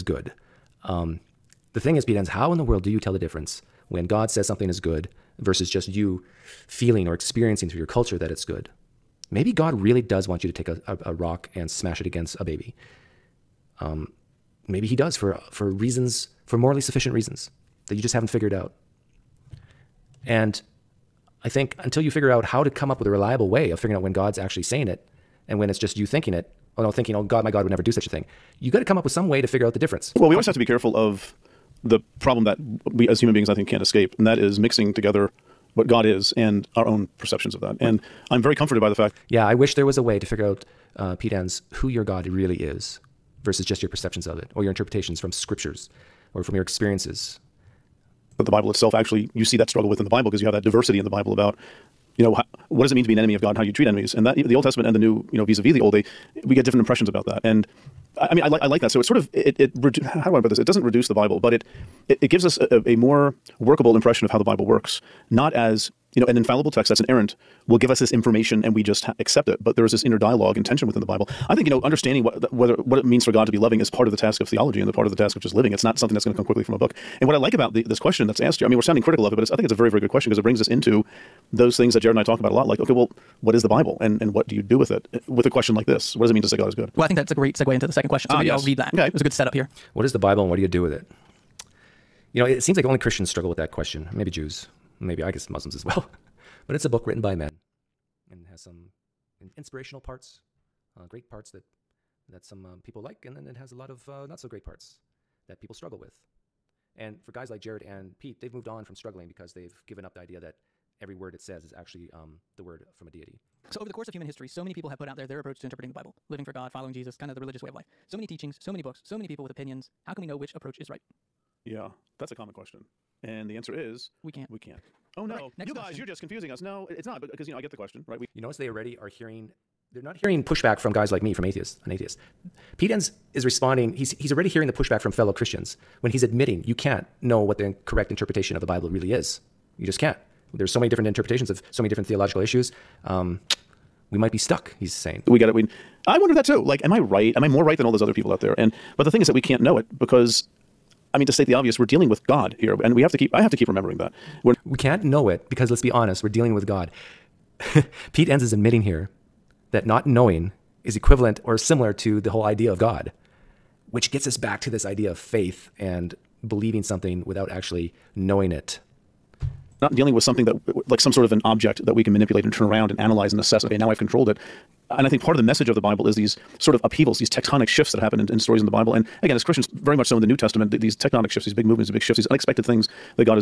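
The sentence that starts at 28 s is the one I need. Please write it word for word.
You got to come up with some way to figure out the difference.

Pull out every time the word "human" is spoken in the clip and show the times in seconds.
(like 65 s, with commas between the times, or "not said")
33 s, 114 s.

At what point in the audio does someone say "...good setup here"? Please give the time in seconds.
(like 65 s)
89 s.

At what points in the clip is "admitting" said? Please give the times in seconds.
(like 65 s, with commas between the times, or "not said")
136 s, 158 s.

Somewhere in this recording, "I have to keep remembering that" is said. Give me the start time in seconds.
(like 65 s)
153 s.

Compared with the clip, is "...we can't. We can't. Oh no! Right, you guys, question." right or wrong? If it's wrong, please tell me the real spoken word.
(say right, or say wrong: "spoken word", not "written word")
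right.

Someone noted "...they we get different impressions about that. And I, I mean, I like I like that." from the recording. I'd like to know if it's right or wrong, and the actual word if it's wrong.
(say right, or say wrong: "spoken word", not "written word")
right.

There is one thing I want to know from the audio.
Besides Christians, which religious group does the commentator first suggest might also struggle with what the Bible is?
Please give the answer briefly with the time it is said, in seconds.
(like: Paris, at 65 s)
Jews, at 94 s.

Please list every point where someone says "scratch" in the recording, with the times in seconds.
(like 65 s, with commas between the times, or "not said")
not said.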